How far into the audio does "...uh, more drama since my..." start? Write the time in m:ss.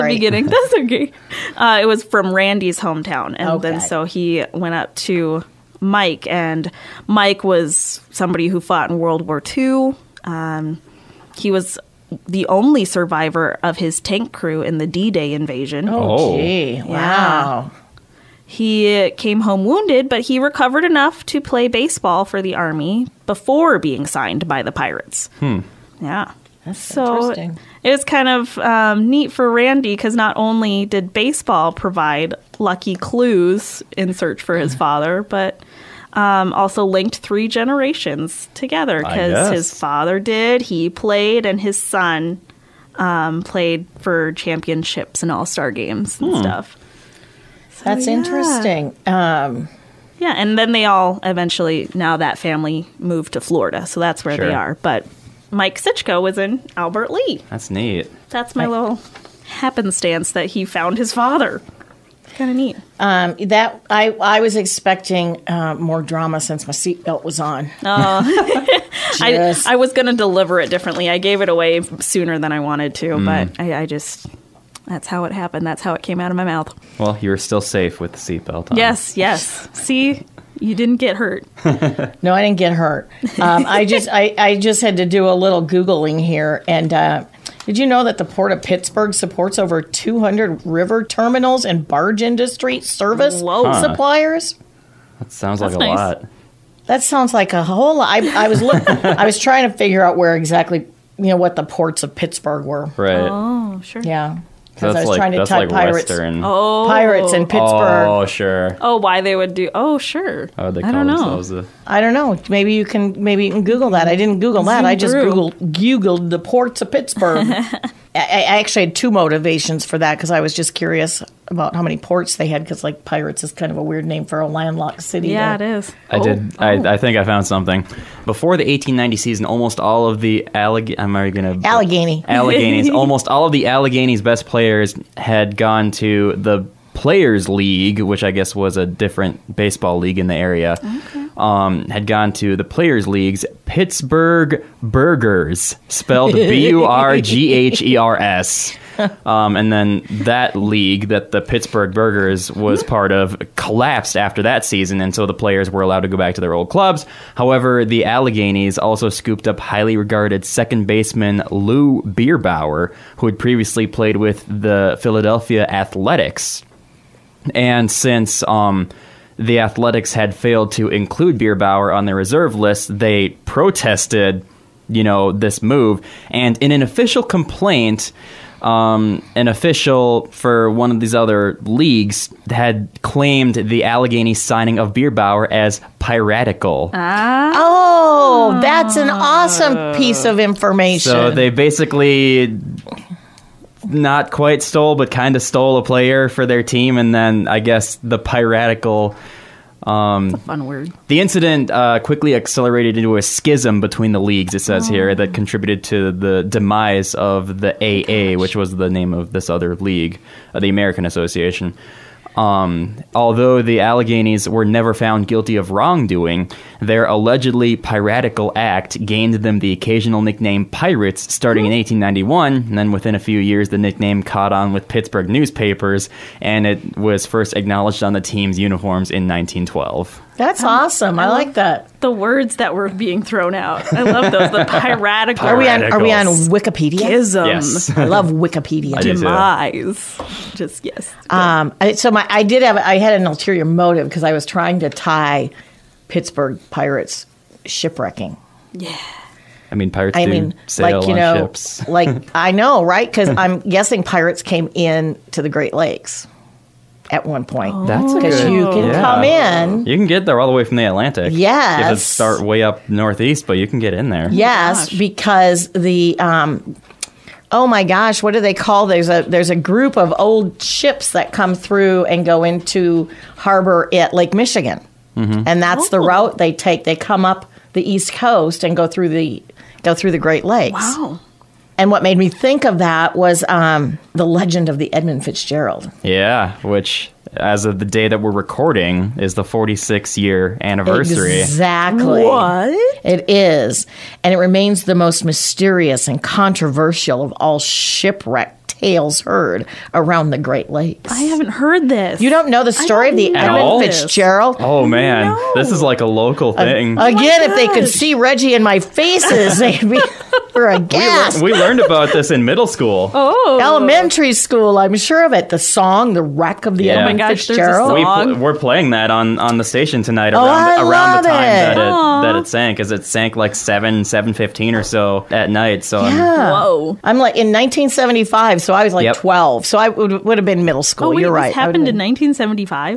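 1:05.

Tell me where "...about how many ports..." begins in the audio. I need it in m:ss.
2:01.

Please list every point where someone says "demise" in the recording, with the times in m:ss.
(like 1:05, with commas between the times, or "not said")
3:26, 3:59.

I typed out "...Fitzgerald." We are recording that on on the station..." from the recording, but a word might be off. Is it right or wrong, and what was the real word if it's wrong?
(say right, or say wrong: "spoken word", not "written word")
wrong: "playing", not "recording".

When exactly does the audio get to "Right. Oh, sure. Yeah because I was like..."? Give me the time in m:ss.
1:42.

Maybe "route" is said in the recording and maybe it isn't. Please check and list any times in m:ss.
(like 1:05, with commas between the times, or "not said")
4:36.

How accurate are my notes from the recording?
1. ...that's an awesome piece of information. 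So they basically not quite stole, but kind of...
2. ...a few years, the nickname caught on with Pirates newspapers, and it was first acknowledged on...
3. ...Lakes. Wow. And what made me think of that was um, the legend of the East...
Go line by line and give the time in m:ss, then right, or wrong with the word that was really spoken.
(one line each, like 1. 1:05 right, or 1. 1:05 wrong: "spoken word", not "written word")
1. 3:08 right
2. 3:43 wrong: "Pittsburgh", not "Pirates"
3. 4:40 wrong: "Edmund", not "East".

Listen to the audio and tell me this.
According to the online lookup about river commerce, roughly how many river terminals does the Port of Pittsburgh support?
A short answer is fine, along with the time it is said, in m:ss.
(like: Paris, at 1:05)
over 200, at 1:29.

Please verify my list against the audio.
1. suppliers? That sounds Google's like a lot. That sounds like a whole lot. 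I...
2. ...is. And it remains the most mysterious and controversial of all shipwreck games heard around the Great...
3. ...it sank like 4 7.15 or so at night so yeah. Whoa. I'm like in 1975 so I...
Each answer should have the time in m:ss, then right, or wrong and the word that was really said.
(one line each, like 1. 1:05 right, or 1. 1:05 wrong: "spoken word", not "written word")
1. 1:33 wrong: "That", not "Google"
2. 4:53 wrong: "tales", not "games"
3. 5:22 wrong: "7", not "4".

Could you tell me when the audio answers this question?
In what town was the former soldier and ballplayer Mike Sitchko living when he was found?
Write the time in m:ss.
0:56.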